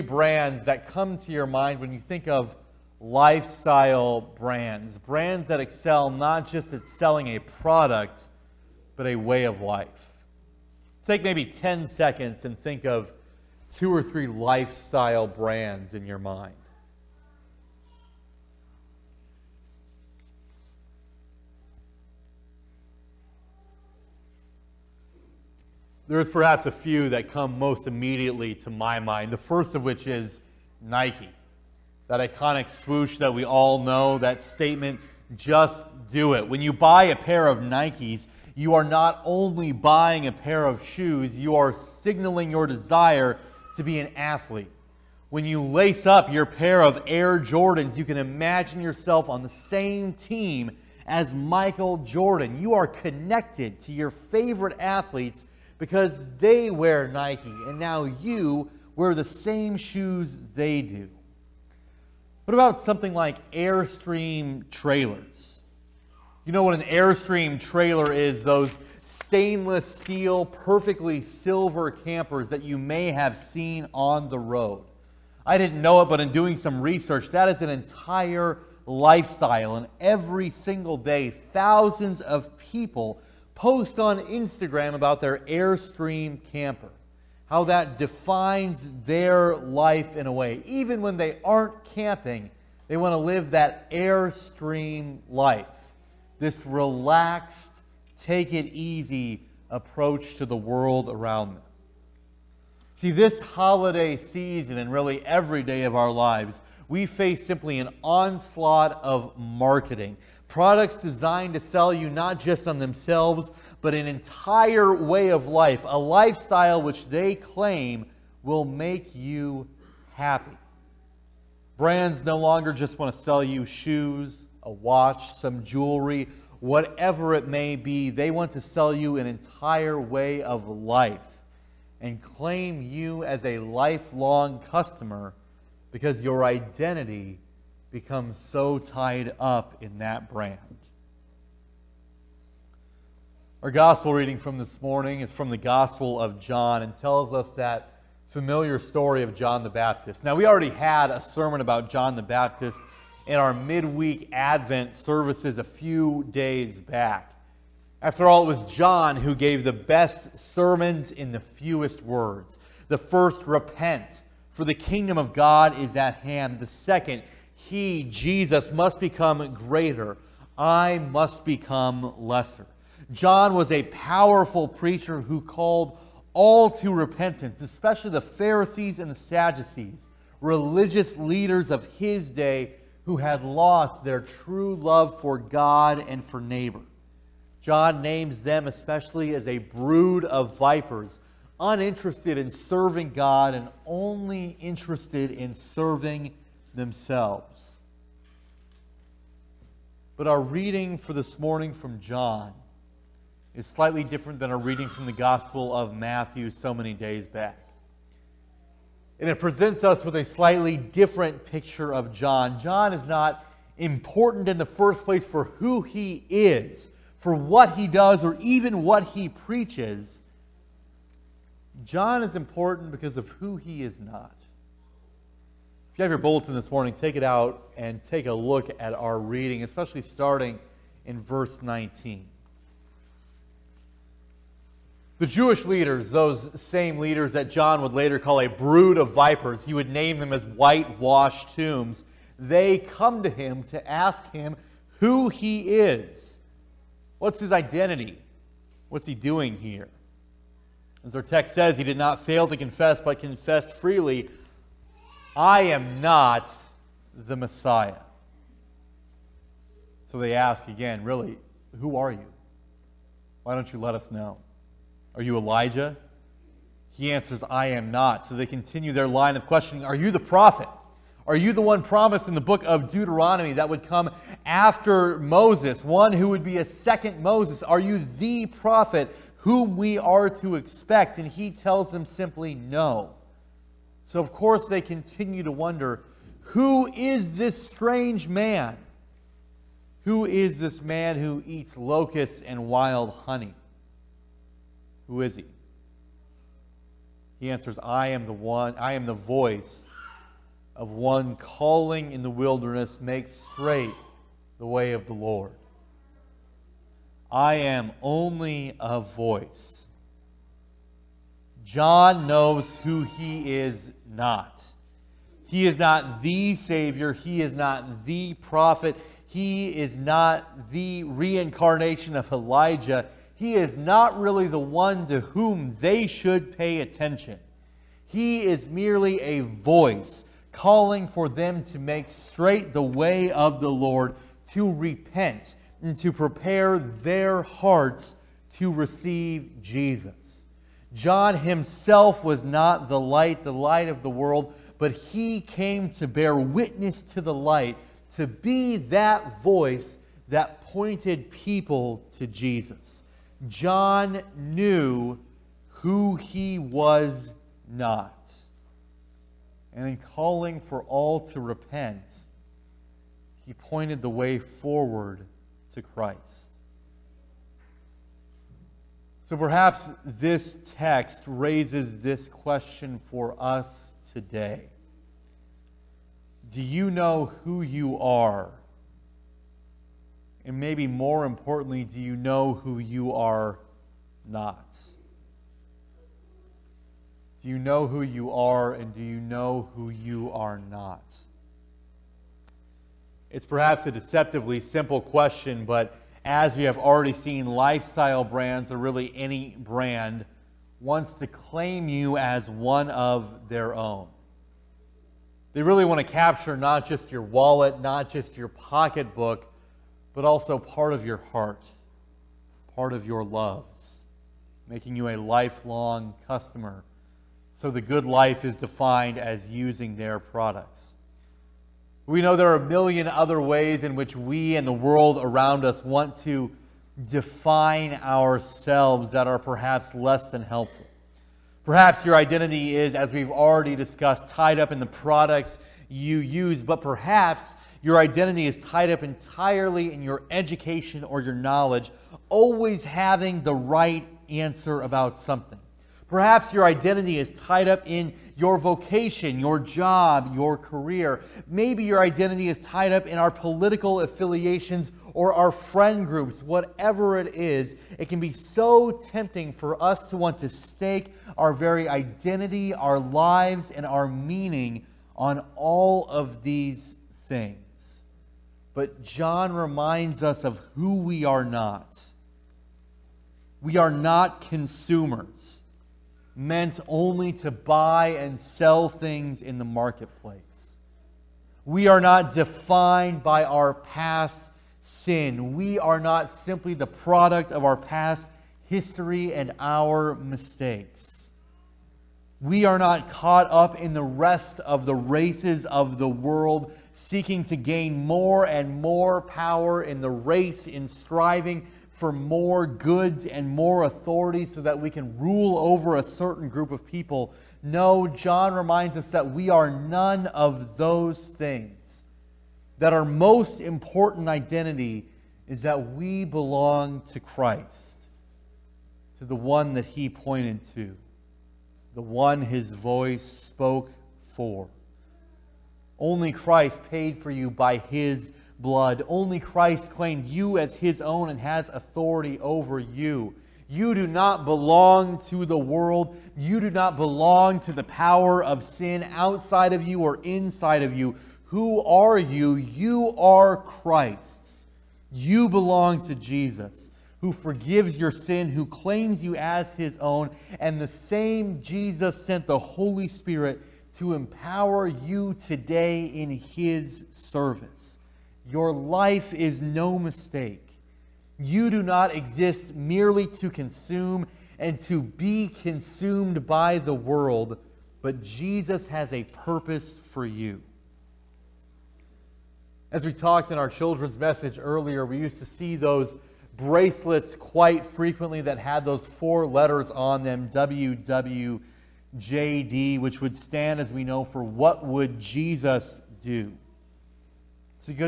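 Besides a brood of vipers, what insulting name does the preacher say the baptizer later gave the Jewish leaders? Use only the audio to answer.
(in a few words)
whitewashed tombs.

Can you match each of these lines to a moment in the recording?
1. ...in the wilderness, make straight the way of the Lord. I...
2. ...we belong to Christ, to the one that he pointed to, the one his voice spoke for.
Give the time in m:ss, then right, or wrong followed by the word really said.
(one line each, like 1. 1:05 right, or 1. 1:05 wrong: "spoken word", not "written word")
1. 5:02 right
2. 8:35 right.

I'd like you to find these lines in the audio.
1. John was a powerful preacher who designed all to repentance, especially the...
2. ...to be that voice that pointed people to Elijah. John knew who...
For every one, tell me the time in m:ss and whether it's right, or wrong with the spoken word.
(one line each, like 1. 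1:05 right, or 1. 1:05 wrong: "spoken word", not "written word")
1. 2:53 wrong: "called", not "designed"
2. 5:48 wrong: "Jesus", not "Elijah".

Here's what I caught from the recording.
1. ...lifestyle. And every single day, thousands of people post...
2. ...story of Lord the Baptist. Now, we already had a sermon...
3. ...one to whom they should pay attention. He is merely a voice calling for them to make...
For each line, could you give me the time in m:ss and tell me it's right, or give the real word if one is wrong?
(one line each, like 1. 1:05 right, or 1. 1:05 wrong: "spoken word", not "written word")
1. 1:18 right
2. 2:28 wrong: "John", not "Lord"
3. 5:24 right.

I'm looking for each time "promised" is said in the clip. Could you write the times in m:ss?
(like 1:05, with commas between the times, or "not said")
4:31.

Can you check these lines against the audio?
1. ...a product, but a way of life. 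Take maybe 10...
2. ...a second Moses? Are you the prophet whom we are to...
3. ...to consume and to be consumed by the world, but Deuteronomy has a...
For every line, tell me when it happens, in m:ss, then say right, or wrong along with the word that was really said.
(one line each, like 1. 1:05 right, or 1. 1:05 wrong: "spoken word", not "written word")
1. 0:07 right
2. 4:36 right
3. 9:23 wrong: "Jesus", not "Deuteronomy".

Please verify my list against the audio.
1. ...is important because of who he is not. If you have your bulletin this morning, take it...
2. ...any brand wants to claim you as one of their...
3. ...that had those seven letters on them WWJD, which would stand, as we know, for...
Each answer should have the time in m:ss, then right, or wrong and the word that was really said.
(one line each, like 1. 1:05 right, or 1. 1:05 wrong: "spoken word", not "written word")
1. 3:42 right
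2. 6:39 right
3. 9:38 wrong: "four", not "seven".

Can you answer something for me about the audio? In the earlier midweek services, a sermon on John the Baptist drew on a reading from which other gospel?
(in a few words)
Matthew.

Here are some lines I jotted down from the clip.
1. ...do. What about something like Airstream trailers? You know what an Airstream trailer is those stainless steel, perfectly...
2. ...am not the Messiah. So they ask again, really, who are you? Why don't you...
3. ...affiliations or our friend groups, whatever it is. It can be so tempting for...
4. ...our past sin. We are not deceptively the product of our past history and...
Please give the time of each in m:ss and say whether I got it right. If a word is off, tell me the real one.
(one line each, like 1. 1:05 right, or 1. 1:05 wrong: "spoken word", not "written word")
1. 1:00 right
2. 4:15 right
3. 7:34 right
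4. 8:03 wrong: "simply", not "deceptively".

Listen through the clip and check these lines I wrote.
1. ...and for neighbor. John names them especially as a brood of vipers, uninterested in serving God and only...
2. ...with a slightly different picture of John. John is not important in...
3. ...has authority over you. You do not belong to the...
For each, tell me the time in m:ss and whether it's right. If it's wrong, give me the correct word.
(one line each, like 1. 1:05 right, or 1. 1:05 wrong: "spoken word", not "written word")
1. 3:06 right
2. 3:30 right
3. 8:51 right.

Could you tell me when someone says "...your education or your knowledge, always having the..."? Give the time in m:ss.
7:20.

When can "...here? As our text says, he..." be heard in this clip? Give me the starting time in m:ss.
4:09.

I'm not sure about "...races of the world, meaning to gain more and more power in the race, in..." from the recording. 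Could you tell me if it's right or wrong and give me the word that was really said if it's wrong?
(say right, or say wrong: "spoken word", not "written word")
wrong: "seeking", not "meaning".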